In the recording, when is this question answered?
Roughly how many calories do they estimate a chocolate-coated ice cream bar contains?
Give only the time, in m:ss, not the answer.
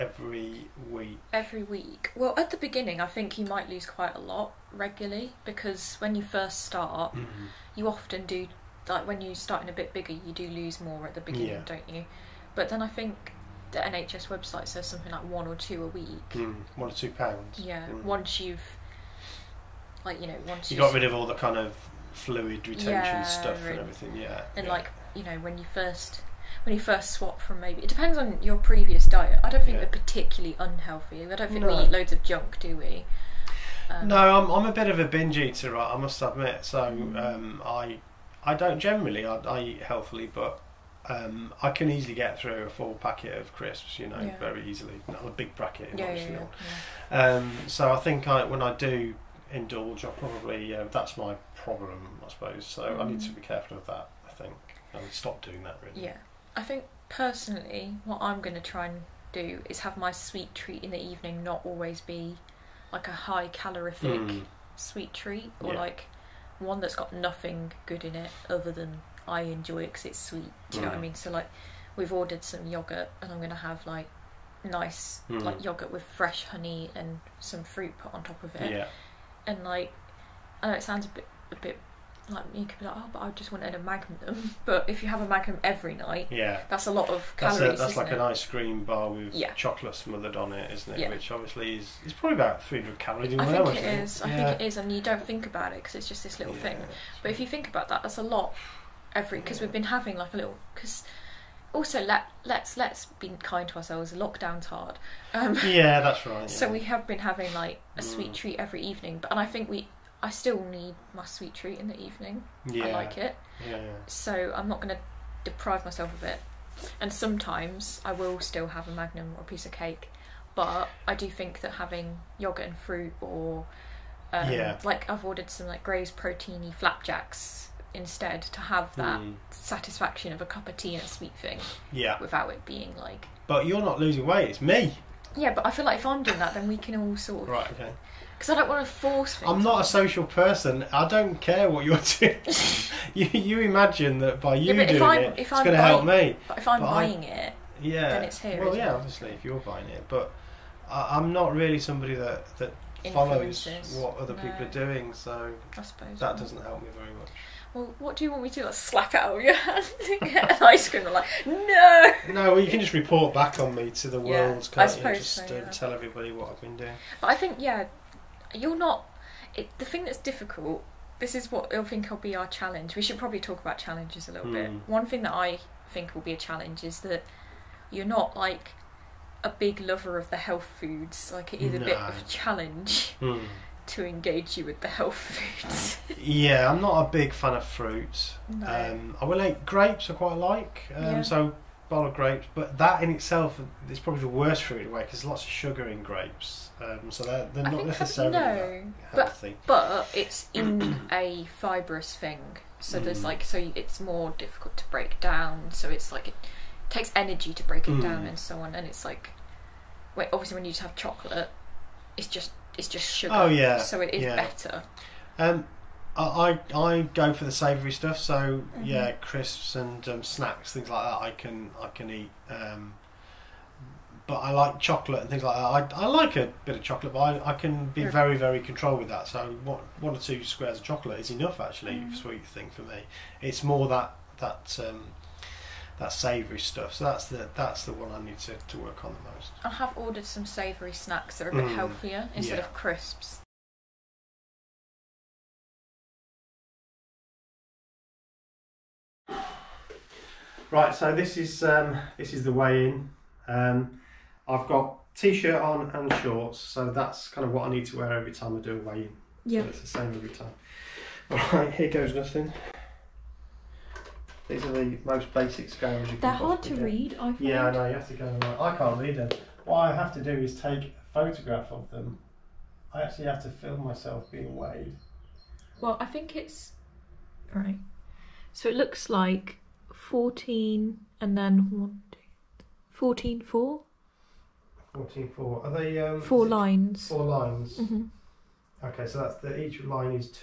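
1:32.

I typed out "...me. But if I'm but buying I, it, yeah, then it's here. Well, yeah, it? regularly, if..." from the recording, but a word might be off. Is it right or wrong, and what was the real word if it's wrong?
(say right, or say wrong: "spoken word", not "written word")
wrong: "obviously", not "regularly".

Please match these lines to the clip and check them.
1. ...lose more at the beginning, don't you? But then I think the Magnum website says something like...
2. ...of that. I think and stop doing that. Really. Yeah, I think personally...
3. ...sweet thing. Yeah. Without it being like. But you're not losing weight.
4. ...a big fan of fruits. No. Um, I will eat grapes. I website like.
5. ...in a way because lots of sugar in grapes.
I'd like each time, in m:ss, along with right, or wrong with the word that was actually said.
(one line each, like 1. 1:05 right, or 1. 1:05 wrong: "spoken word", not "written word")
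1. 0:10 wrong: "NHS", not "Magnum"
2. 0:53 right
3. 2:11 right
4. 3:07 wrong: "quite", not "website"
5. 3:14 right.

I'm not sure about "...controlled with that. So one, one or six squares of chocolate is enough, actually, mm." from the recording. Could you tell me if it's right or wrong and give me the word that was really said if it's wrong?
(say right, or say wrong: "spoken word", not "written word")
wrong: "two", not "six".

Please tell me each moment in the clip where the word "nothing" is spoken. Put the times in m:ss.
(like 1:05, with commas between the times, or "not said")
1:07, 4:22.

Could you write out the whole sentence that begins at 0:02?
Well, at the beginning, I think you might lose quite a lot regularly because when you first start, mm-hmm.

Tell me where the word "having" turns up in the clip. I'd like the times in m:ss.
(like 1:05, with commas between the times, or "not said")
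1:39, 1:47, 2:01.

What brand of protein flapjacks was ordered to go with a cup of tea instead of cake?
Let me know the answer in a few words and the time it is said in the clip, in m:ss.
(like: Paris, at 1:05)
Graze, at 2:05.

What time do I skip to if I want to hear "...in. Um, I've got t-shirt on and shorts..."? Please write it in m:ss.
4:12.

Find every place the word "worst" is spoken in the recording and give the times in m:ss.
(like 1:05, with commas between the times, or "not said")
3:14.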